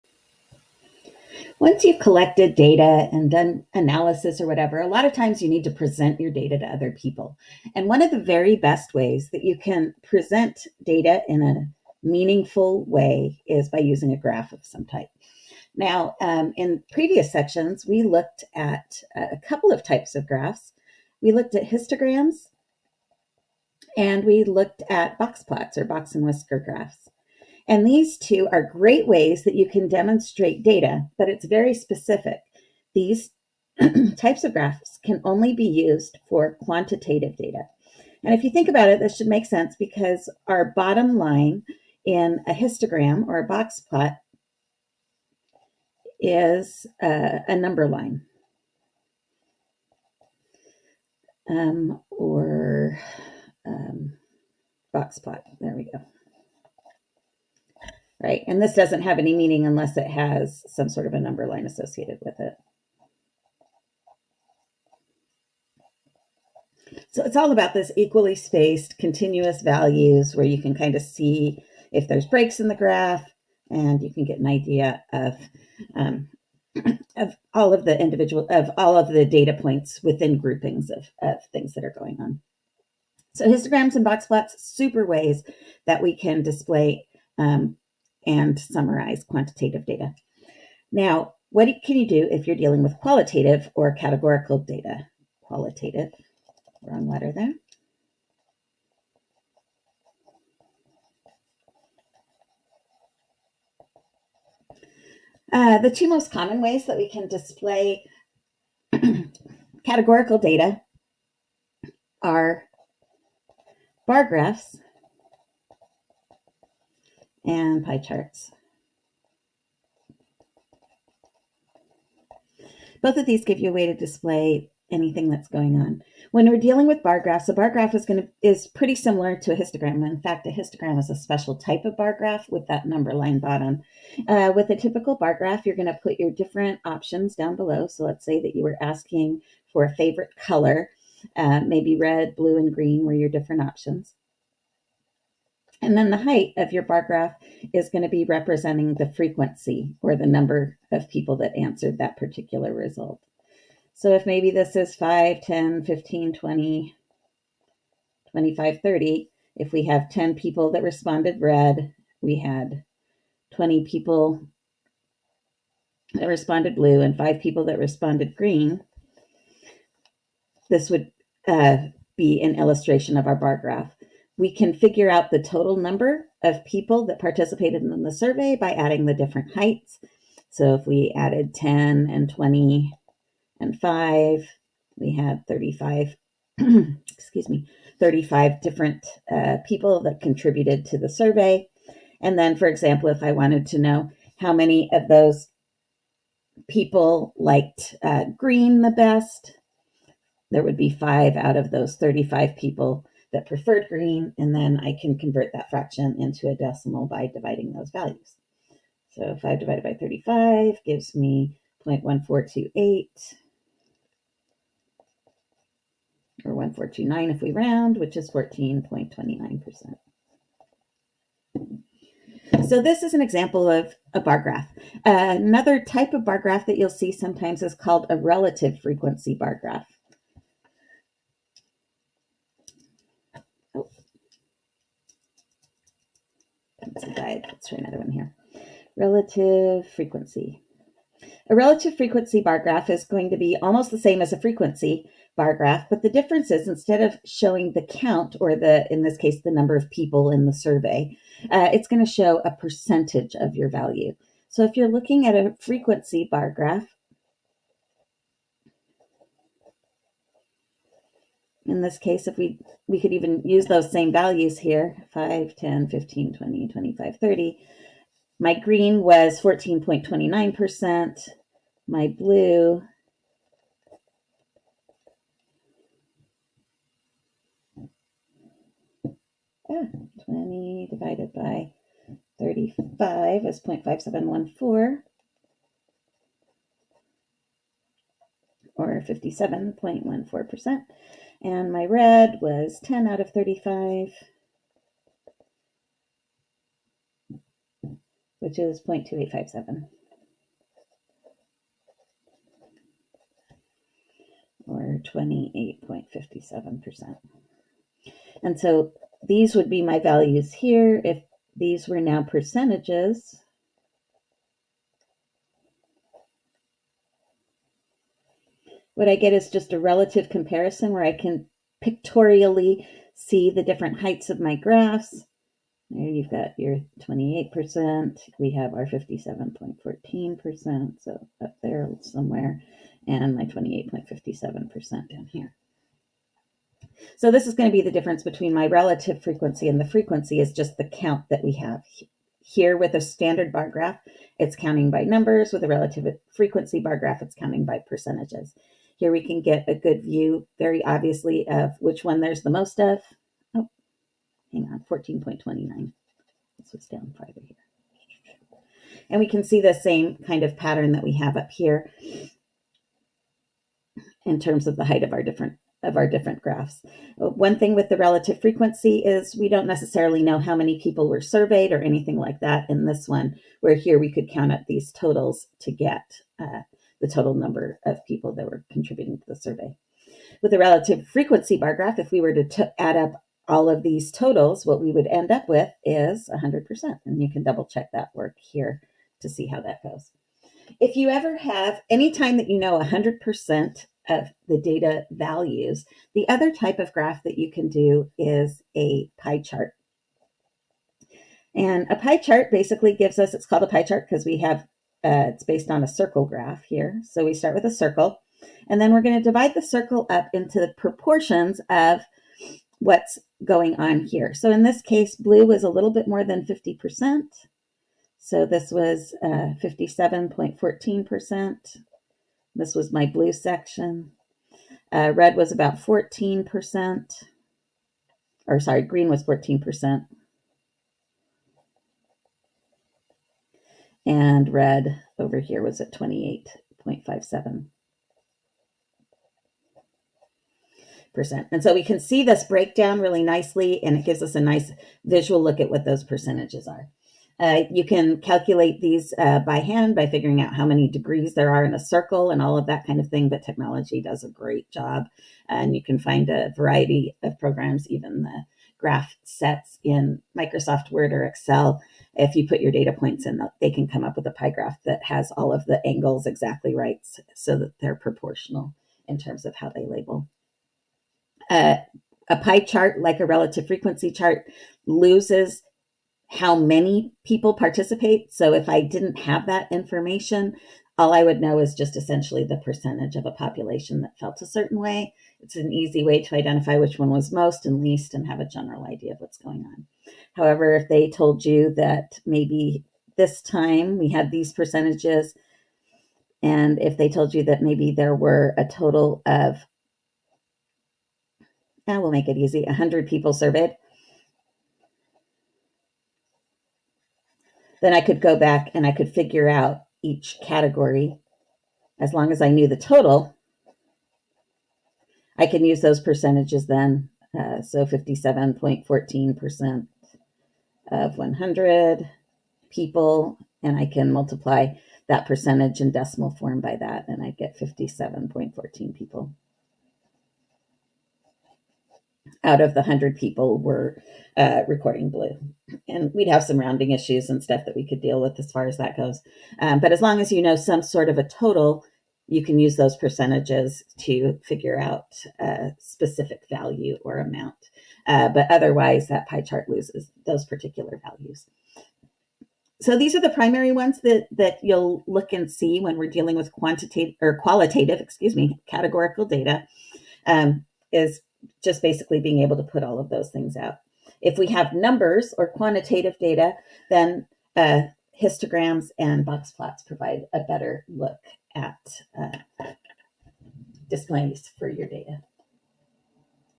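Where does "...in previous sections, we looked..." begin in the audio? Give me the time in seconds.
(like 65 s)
16 s.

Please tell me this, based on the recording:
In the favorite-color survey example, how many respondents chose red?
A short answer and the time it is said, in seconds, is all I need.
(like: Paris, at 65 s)
10, at 160 s.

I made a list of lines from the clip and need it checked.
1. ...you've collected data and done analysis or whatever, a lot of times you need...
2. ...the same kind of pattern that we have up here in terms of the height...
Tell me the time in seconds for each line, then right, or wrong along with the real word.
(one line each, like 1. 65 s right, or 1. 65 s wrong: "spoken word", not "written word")
1. 1 s right
2. 359 s right.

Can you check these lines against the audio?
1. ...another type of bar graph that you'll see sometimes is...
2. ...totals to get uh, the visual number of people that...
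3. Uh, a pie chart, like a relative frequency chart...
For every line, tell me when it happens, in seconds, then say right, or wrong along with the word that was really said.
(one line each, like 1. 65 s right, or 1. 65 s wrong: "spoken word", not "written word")
1. 225 s right
2. 374 s wrong: "total", not "visual"
3. 471 s right.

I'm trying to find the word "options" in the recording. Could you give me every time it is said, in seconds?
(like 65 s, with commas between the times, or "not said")
136 s, 143 s.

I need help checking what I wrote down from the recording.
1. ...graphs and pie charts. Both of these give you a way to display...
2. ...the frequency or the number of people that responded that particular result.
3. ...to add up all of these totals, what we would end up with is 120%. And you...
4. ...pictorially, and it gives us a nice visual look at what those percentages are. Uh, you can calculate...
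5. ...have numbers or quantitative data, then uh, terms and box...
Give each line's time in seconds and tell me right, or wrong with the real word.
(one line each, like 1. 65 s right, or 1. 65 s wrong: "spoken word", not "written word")
1. 114 s right
2. 148 s wrong: "answered", not "responded"
3. 382 s wrong: "100", not "120"
4. 443 s wrong: "nicely", not "pictorially"
5. 564 s wrong: "histograms", not "terms".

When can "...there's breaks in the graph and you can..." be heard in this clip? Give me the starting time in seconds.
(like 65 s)
72 s.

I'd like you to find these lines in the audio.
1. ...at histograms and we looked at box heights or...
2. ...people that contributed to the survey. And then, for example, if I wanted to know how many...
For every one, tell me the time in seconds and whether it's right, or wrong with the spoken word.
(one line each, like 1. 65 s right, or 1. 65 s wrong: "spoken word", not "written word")
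1. 21 s wrong: "plots", not "heights"
2. 189 s right.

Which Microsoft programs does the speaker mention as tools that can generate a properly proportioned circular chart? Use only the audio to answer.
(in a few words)
Word or Excel.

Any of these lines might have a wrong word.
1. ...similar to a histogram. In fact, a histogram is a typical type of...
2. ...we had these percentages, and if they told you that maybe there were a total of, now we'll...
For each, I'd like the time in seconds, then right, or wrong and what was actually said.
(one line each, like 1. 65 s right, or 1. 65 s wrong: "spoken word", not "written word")
1. 128 s wrong: "special", not "typical"
2. 493 s right.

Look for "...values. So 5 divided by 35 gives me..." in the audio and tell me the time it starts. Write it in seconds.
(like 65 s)
207 s.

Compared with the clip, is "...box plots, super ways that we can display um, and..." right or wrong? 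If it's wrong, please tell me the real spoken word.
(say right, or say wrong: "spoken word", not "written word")
right.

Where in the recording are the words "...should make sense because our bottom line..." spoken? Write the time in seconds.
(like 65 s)
39 s.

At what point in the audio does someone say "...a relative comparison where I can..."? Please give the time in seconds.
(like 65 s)
319 s.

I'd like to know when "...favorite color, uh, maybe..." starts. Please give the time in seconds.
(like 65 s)
139 s.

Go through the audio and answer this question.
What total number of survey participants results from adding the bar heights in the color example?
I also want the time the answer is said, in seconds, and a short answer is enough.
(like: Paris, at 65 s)
35, at 184 s.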